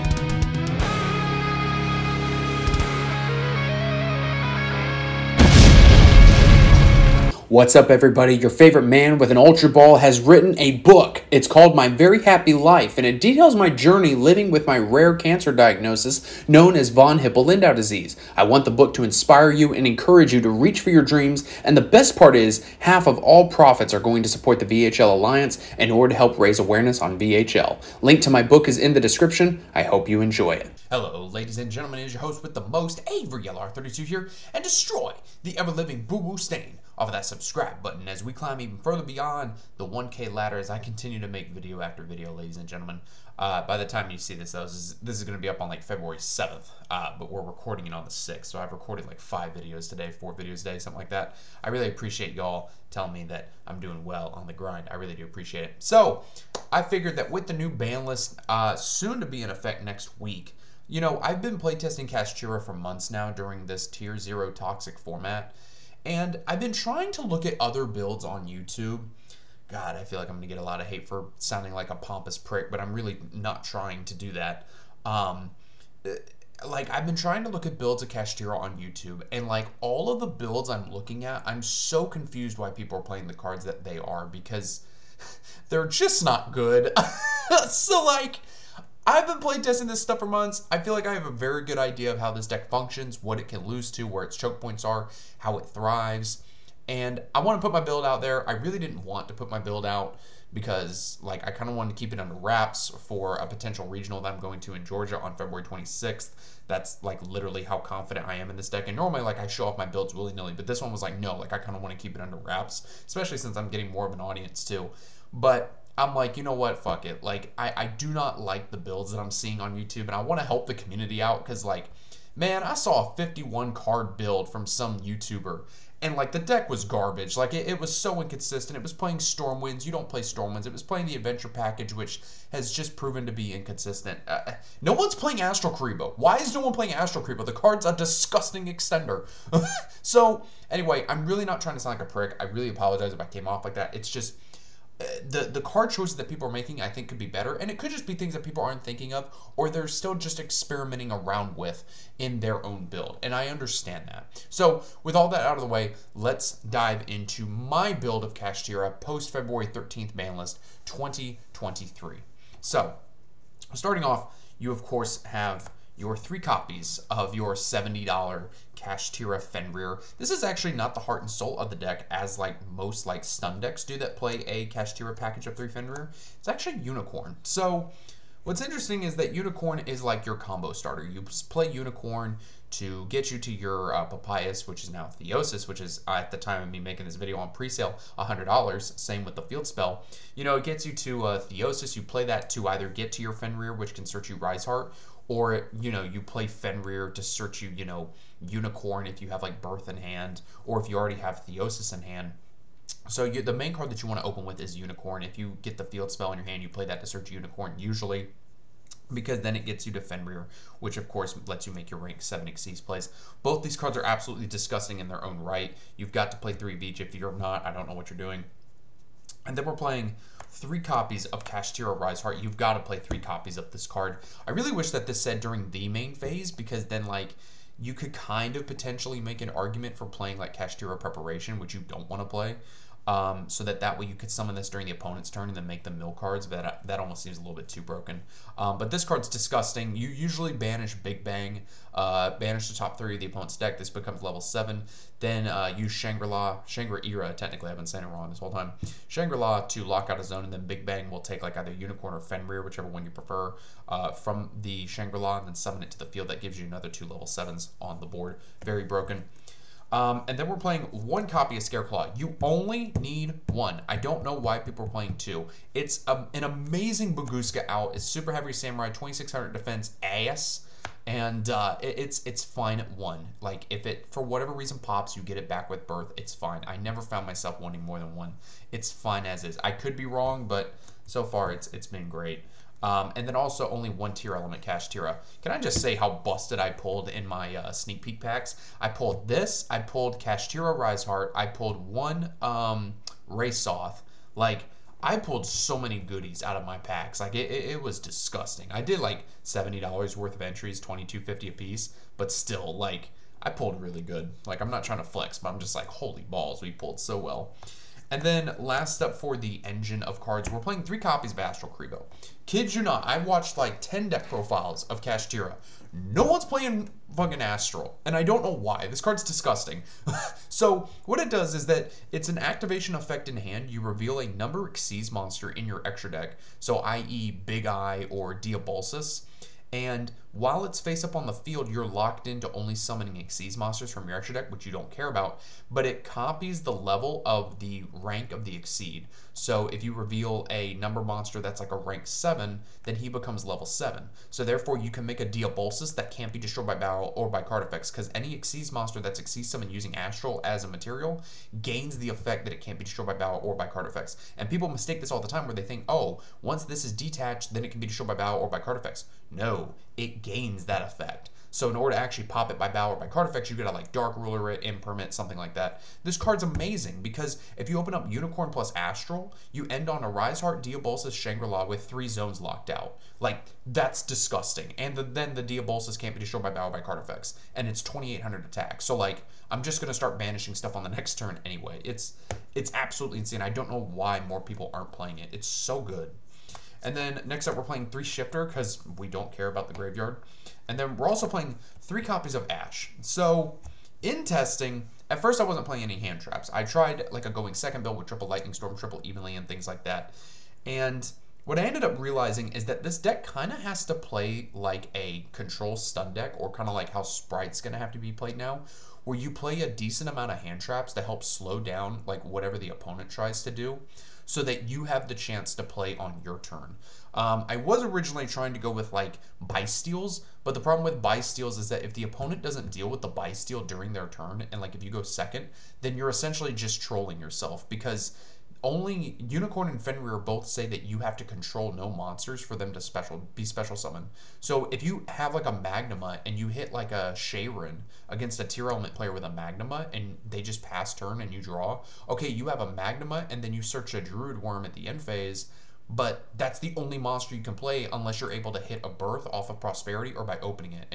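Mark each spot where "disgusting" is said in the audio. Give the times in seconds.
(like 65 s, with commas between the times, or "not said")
137 s, 214 s, 239 s, 297 s, 319 s, 374 s.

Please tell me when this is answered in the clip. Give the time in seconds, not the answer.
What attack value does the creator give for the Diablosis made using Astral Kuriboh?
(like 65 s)
377 s.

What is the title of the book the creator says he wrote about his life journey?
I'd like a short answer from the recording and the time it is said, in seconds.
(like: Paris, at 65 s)
My Very Happy Life, at 11 s.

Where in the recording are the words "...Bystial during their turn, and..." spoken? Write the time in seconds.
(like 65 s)
423 s.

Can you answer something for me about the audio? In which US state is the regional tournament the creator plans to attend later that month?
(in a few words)
Georgia.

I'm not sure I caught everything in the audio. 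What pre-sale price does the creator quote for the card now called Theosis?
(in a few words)
$100.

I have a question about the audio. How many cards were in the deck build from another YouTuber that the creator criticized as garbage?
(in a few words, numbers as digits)
51.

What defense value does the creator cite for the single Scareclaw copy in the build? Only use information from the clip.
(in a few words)
2600.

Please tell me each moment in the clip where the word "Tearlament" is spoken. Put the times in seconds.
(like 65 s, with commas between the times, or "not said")
284 s, 438 s.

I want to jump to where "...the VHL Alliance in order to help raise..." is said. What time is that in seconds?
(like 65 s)
24 s.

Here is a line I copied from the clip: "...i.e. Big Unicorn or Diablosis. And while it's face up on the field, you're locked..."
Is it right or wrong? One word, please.
wrong.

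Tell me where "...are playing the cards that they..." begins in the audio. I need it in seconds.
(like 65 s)
82 s.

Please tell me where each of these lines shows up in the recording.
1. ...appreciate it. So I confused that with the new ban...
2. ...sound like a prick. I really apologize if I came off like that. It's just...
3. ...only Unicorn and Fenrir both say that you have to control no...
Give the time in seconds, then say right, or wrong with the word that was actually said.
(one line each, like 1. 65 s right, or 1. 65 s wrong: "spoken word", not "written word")
1. 55 s wrong: "figured", not "confused"
2. 141 s right
3. 428 s right.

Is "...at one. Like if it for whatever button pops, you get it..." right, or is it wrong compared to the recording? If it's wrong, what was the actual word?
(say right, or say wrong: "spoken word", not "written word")
wrong: "reason", not "button".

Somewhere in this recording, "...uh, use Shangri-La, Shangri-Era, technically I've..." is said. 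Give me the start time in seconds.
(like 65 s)
245 s.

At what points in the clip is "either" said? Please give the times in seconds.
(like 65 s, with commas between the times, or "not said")
192 s, 251 s.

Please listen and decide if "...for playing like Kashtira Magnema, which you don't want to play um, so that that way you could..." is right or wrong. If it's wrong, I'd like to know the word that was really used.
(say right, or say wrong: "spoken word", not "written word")
wrong: "Preparation", not "Magnema".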